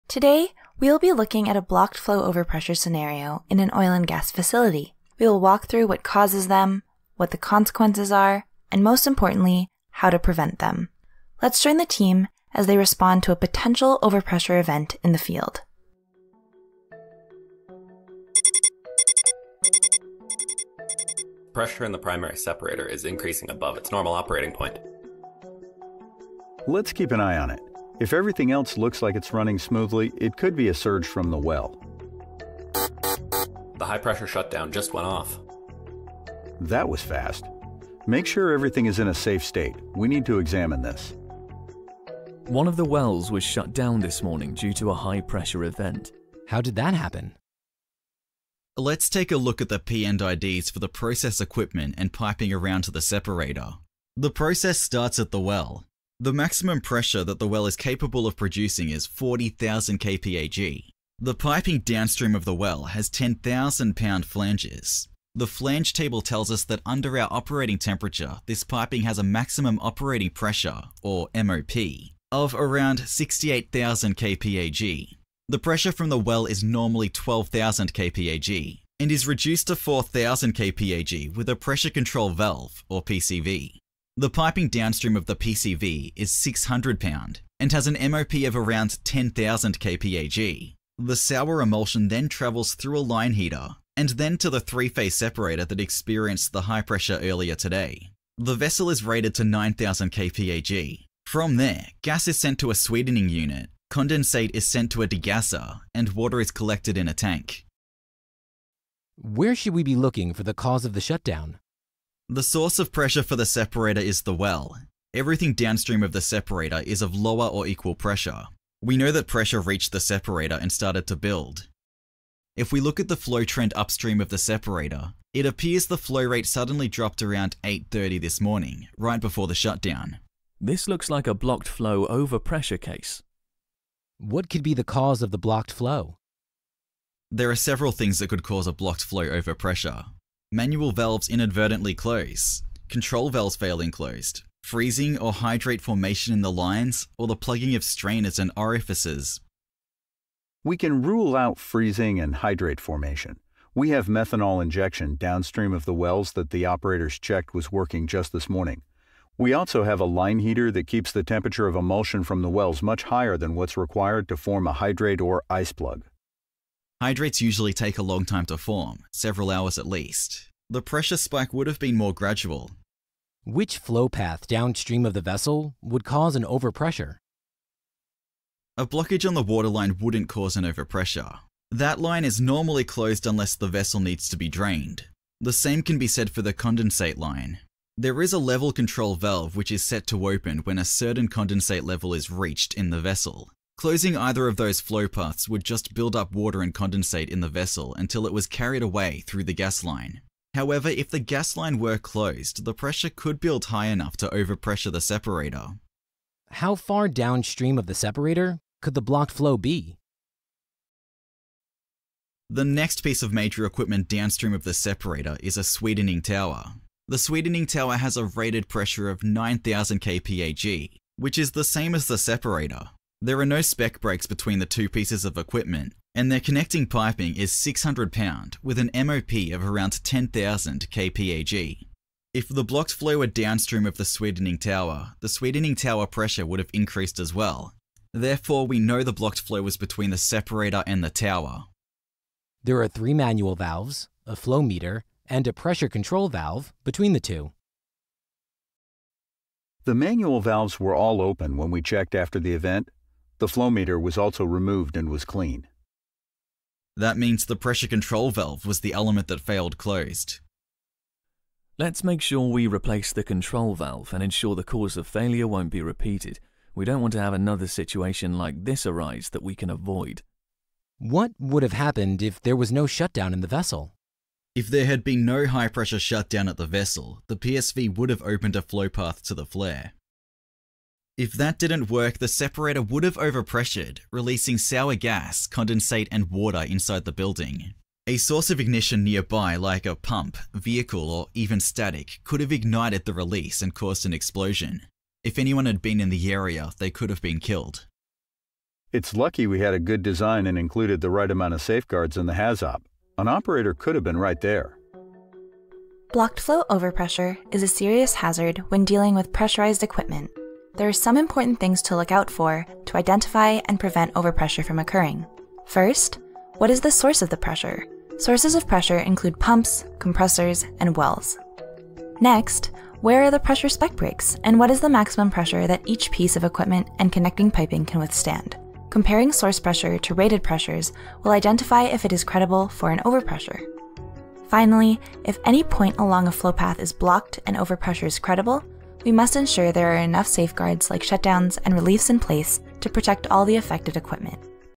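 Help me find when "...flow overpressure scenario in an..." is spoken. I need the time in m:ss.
0:01.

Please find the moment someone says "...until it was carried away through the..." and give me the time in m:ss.
3:17.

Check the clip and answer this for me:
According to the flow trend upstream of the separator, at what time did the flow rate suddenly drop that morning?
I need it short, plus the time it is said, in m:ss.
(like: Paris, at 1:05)
8:30, at 2:07.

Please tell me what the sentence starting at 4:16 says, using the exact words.
That means the pressure control valve was the element that failed closed.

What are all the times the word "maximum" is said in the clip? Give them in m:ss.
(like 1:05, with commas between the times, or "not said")
0:56, 1:09, 5:24.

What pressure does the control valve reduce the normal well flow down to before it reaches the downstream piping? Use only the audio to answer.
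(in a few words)
4,000 kPag.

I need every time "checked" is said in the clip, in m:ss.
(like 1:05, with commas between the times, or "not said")
2:37, 4:11.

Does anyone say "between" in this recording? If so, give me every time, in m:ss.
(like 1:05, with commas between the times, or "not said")
3:44, 3:59, 4:06.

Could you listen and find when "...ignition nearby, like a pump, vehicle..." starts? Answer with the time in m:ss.
4:48.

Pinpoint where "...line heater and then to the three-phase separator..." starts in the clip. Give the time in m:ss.
1:32.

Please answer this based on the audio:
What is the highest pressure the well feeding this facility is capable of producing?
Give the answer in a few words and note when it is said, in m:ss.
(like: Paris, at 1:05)
40,000 kPag, at 0:59.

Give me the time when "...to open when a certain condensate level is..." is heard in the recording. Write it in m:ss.
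3:10.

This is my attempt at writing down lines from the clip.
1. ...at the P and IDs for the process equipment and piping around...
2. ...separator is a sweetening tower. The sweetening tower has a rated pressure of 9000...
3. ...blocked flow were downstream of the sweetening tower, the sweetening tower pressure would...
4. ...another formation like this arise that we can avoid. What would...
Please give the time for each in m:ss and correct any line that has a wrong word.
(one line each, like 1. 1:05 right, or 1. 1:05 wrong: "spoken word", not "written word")
1. 0:49 right
2. 3:34 right
3. 3:52 right
4. 4:27 wrong: "situation", not "formation".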